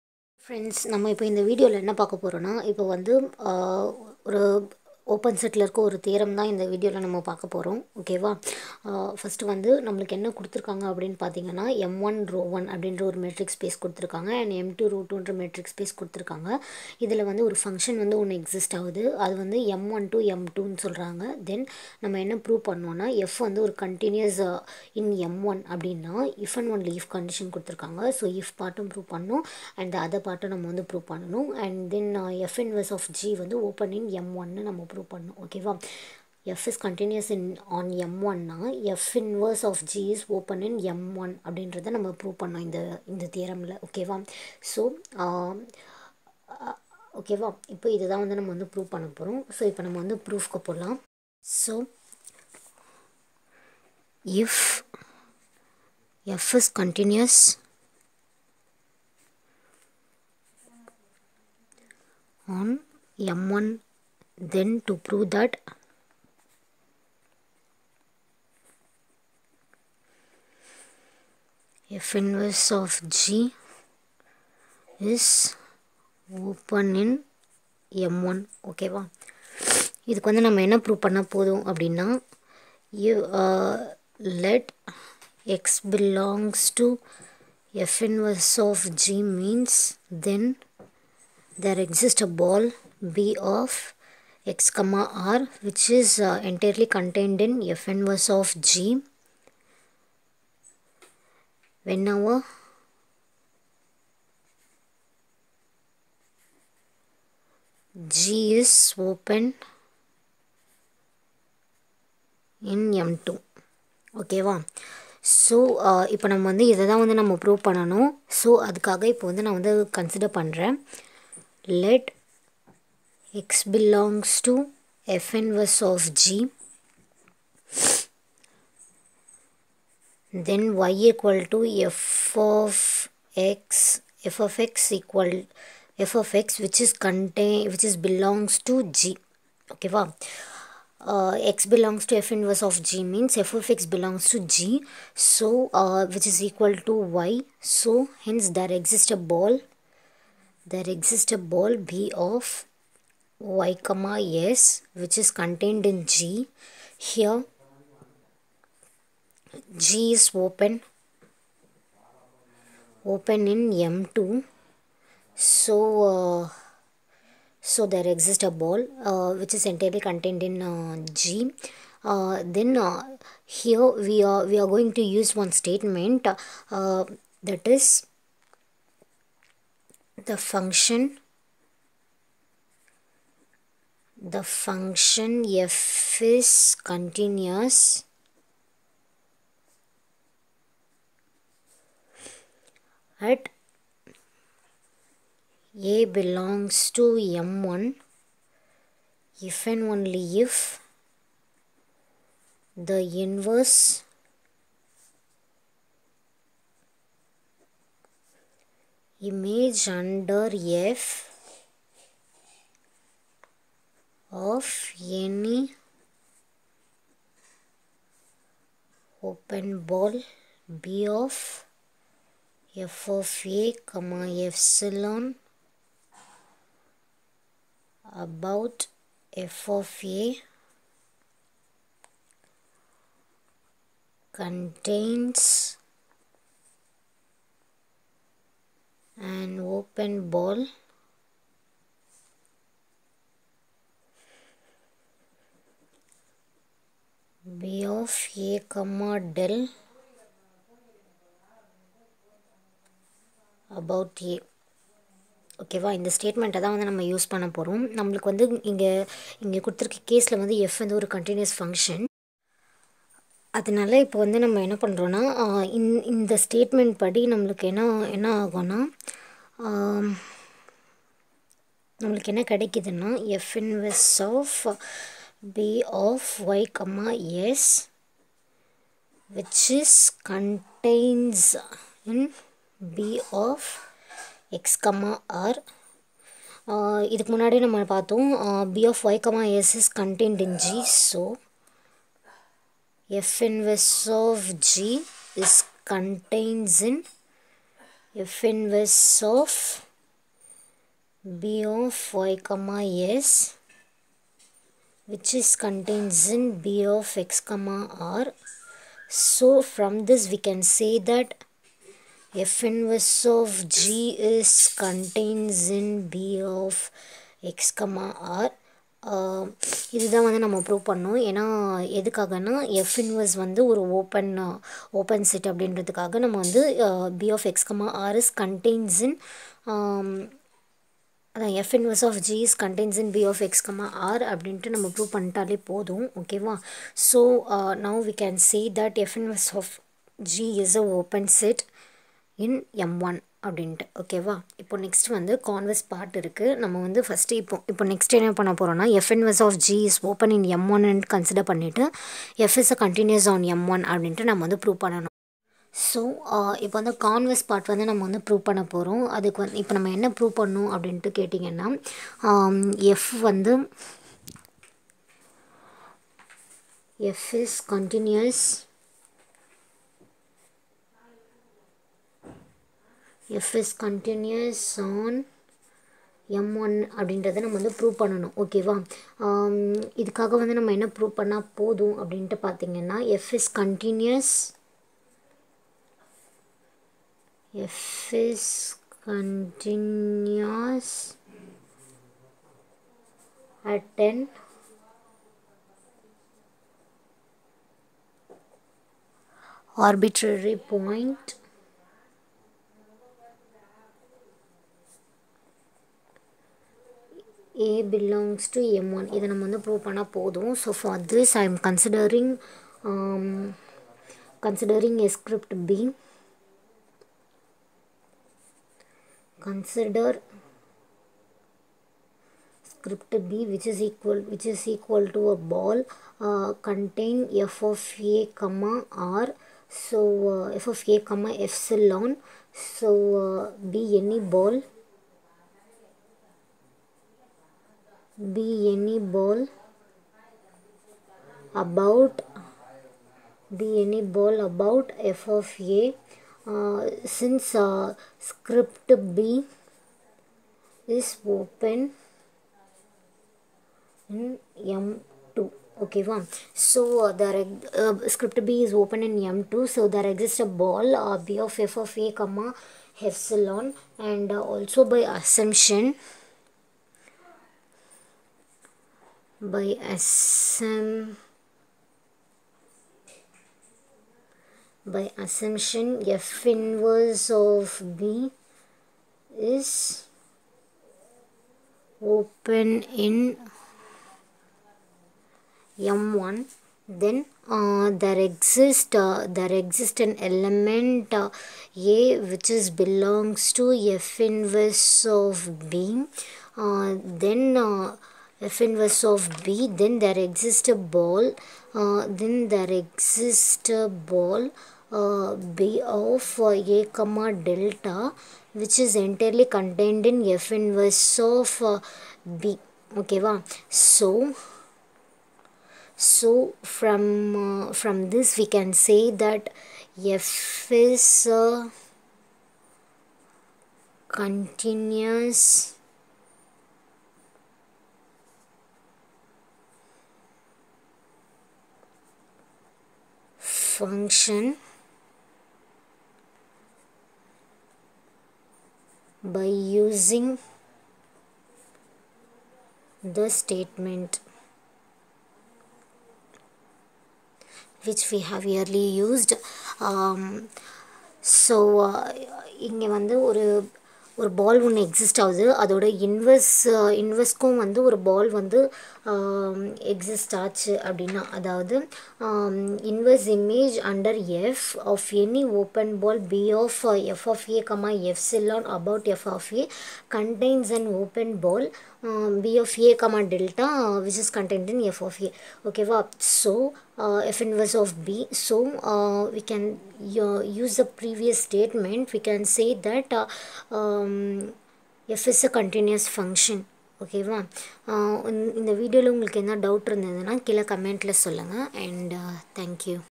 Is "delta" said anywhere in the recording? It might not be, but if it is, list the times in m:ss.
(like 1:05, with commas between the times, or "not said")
8:27, 9:33.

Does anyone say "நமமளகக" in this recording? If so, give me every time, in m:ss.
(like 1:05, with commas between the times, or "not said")
0:09, 4:17, 4:27, 4:32.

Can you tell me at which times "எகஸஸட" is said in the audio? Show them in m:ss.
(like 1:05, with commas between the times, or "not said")
0:18, 1:31, 9:14, 9:19.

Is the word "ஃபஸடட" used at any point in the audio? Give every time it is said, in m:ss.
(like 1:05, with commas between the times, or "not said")
0:09, 5:47.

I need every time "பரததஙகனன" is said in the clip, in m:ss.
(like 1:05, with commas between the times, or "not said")
0:11, 6:22.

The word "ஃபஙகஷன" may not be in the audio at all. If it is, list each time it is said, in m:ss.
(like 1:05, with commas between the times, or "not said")
0:17, 4:21.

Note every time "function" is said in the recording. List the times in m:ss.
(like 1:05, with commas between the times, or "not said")
3:00, 3:04, 8:53, 9:46.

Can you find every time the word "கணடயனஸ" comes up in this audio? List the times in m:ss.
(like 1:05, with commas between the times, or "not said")
5:28, 5:32, 9:30.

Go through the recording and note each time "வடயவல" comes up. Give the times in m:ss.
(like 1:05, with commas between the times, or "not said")
0:01, 0:06, 9:48.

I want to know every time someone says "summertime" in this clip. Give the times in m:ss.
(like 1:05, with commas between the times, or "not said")
not said.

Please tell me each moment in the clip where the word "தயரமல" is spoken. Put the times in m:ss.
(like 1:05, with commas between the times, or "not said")
0:43.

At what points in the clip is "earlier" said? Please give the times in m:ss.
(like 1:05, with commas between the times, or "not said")
9:08.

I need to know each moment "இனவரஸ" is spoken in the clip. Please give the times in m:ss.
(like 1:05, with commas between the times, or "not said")
0:32, 0:39, 1:28, 5:23, 5:31, 5:39.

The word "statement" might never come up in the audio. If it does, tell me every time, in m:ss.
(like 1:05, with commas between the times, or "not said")
2:55, 9:03, 9:41.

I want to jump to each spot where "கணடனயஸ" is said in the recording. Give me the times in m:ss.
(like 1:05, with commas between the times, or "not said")
0:23, 0:36, 0:56, 4:21, 5:52, 6:07, 6:13, 6:23.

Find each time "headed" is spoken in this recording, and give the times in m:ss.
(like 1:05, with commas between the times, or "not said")
not said.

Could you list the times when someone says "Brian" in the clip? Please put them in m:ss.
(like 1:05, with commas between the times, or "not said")
not said.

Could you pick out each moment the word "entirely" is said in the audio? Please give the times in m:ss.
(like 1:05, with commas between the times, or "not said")
1:36, 2:49, 8:28.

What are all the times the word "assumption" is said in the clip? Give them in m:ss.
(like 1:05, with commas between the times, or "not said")
7:45, 7:49, 7:55.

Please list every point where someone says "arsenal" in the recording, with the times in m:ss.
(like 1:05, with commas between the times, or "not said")
not said.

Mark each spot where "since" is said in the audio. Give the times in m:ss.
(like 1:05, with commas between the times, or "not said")
7:27.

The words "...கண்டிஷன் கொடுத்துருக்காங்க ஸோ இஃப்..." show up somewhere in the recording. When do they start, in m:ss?
0:27.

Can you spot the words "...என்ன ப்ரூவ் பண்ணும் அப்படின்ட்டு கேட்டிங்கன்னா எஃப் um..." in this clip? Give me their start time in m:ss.
5:59.